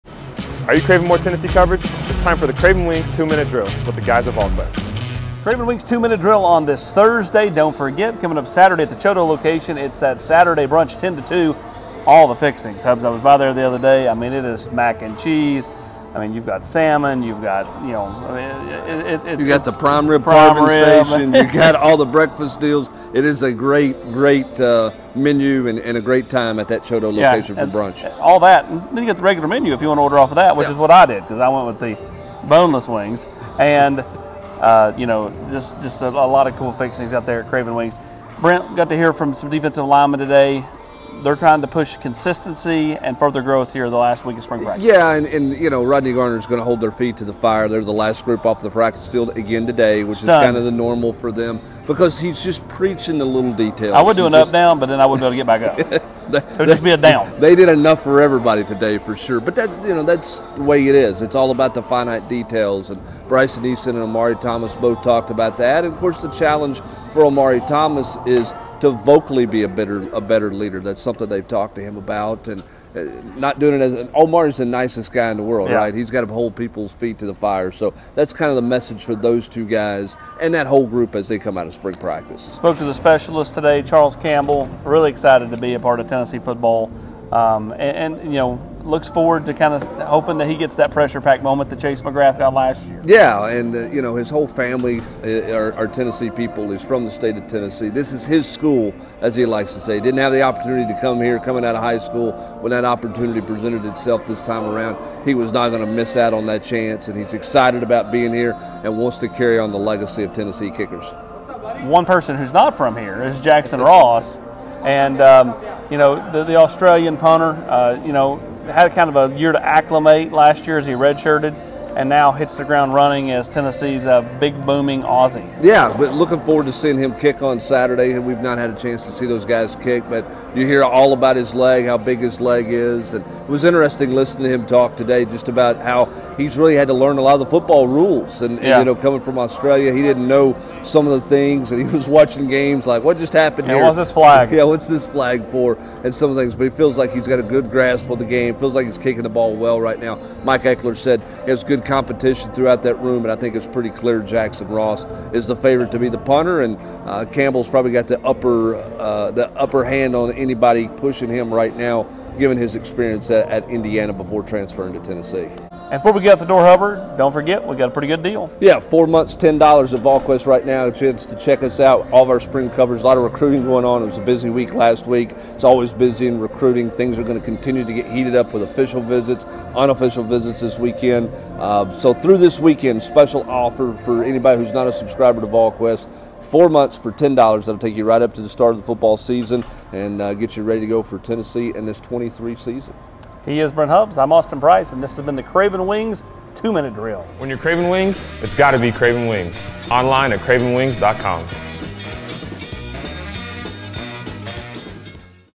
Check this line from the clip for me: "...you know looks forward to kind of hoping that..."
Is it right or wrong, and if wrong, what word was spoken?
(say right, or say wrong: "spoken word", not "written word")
right.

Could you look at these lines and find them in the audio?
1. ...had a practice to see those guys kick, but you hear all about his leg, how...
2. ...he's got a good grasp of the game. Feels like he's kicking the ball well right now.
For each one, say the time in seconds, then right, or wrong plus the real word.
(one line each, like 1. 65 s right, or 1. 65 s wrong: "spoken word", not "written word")
1. 128 s wrong: "chance", not "practice"
2. 147 s right.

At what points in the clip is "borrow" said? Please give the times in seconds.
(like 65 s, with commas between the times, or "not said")
not said.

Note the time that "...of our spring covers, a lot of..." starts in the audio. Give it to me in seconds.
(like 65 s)
172 s.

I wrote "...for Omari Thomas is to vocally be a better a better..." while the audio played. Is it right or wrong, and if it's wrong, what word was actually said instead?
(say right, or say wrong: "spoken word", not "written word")
right.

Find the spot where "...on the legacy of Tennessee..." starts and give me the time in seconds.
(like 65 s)
109 s.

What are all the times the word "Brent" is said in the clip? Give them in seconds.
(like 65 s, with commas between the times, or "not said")
38 s, 193 s.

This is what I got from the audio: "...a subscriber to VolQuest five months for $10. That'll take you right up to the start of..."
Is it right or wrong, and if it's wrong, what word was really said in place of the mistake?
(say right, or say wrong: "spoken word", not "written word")
wrong: "four", not "five".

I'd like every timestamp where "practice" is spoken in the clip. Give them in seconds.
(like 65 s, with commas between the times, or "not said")
44 s, 48 s, 81 s.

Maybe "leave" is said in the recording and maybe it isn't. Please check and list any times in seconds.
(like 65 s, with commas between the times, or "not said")
not said.